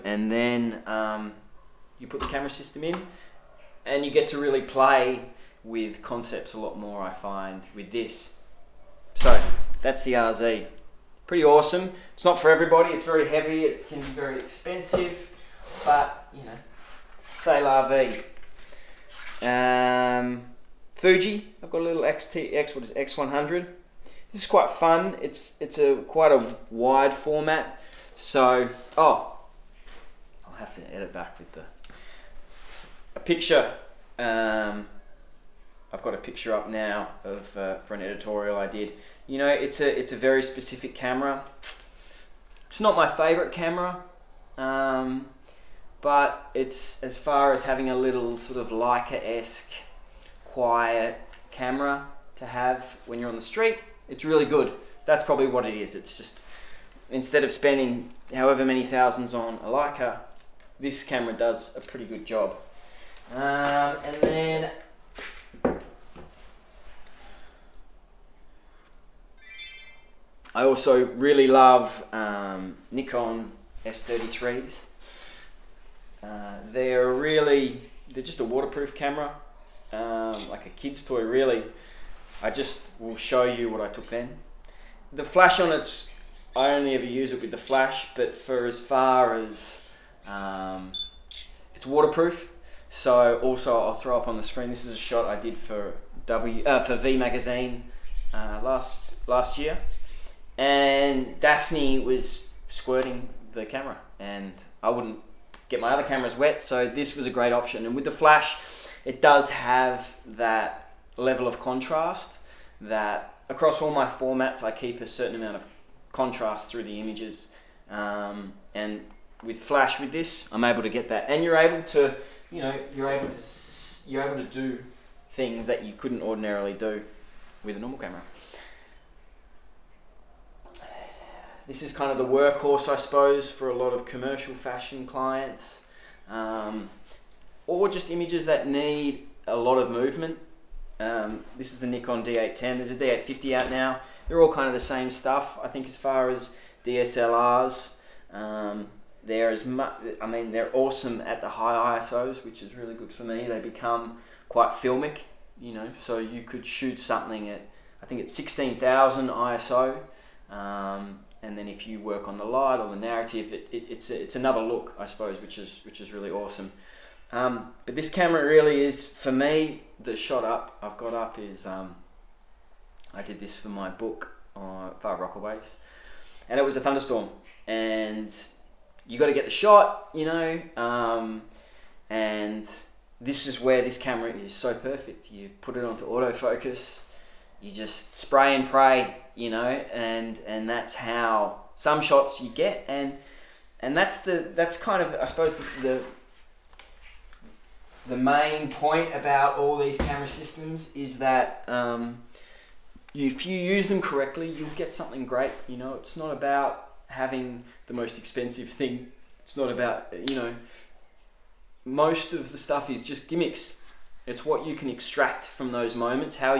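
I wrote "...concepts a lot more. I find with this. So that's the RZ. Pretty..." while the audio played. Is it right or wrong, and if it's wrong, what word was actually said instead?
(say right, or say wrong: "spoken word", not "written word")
right.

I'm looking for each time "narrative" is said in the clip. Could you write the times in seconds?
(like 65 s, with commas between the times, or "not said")
162 s.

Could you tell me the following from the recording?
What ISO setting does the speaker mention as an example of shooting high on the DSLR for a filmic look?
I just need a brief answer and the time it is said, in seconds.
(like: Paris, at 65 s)
16,000, at 158 s.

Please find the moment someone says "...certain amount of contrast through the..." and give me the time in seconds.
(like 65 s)
115 s.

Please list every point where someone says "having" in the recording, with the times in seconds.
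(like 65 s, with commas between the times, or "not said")
47 s, 207 s.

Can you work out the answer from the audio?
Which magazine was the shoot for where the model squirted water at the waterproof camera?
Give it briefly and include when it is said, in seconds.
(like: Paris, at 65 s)
V magazine, at 96 s.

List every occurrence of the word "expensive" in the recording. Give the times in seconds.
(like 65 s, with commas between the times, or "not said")
14 s, 208 s.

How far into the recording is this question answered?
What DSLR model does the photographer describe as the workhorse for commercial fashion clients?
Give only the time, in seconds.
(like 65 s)
141 s.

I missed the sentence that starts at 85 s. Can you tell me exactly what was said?
The flash on it's I only ever use it with the flash, but for as far as um, it's waterproof.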